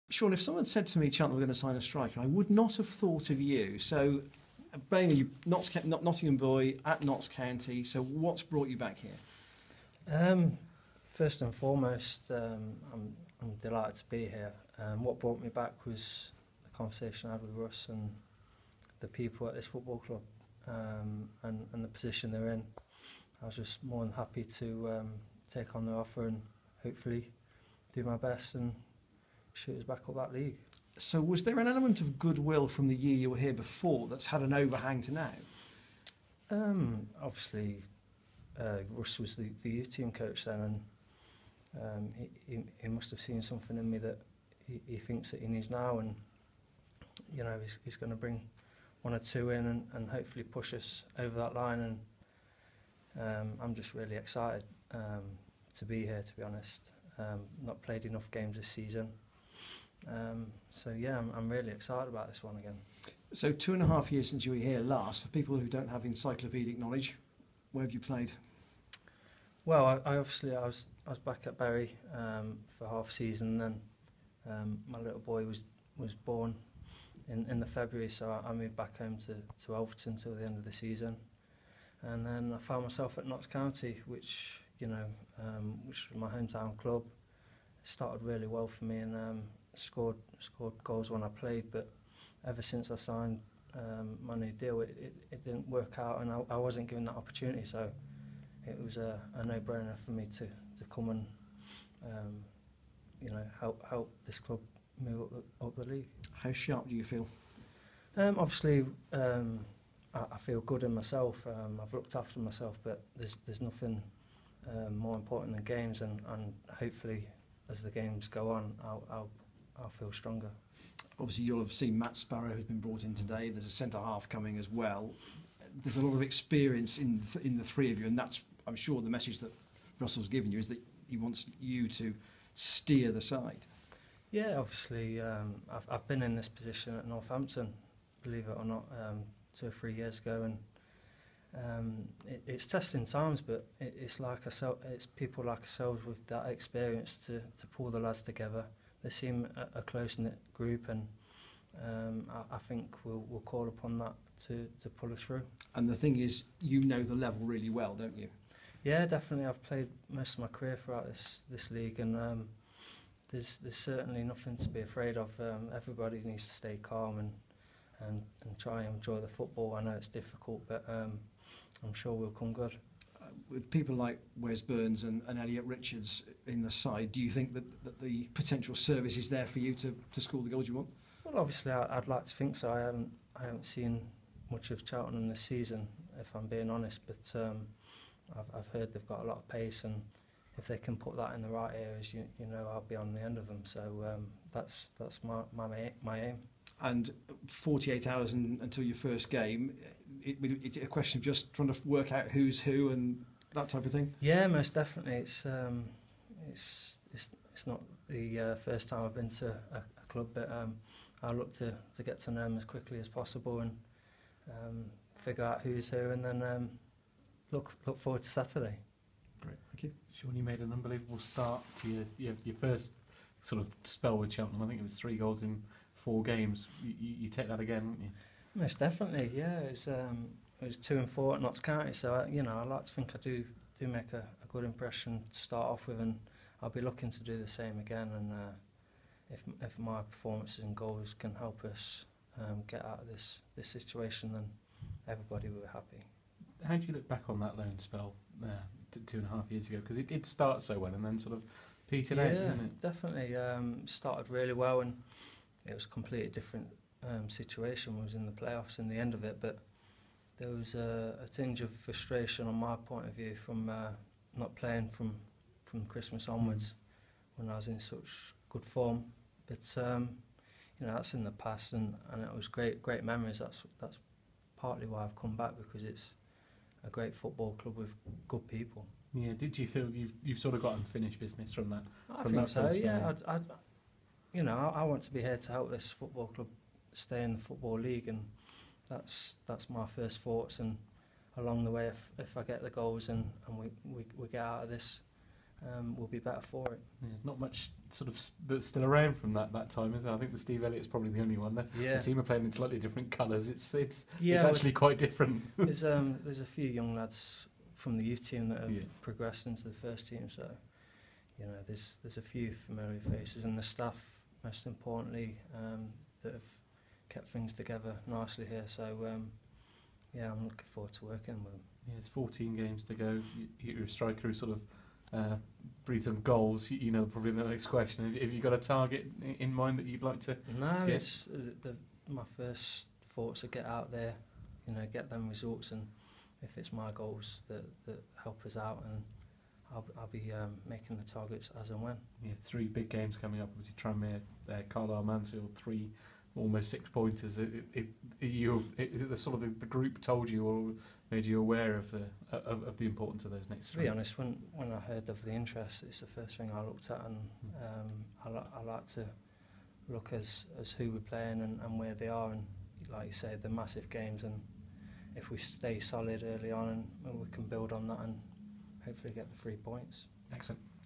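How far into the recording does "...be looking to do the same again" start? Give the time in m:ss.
3:56.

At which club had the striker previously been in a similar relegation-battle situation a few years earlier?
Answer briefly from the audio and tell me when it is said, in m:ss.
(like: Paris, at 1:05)
Northampton, at 2:17.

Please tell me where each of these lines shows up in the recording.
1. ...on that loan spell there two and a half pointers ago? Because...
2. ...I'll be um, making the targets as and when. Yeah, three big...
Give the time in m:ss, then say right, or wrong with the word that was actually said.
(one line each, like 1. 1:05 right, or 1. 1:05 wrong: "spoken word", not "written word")
1. 4:07 wrong: "years", not "pointers"
2. 5:39 right.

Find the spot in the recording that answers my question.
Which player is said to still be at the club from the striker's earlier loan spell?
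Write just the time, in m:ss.
5:00.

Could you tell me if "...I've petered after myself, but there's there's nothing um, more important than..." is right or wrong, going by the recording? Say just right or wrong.
wrong.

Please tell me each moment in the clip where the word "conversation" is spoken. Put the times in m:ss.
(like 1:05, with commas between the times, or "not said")
0:16.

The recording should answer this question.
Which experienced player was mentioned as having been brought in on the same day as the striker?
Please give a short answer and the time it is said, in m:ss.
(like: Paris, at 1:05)
Matt Sparrow, at 2:01.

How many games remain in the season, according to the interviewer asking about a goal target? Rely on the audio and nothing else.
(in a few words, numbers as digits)
14.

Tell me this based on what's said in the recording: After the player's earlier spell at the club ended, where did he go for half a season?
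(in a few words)
Bury.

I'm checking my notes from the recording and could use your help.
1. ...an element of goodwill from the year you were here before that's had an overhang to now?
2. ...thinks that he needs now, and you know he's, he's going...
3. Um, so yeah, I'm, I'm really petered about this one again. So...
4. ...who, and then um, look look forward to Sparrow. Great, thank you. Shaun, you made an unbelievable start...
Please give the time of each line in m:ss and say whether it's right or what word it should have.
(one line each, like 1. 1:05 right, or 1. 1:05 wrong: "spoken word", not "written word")
1. 0:31 right
2. 0:44 right
3. 1:00 wrong: "excited", not "petered"
4. 3:35 wrong: "Saturday", not "Sparrow".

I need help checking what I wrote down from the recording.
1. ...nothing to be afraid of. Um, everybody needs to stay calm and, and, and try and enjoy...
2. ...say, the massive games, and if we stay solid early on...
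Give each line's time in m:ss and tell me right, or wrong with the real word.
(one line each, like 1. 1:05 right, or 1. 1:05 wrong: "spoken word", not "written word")
1. 2:44 right
2. 6:03 right.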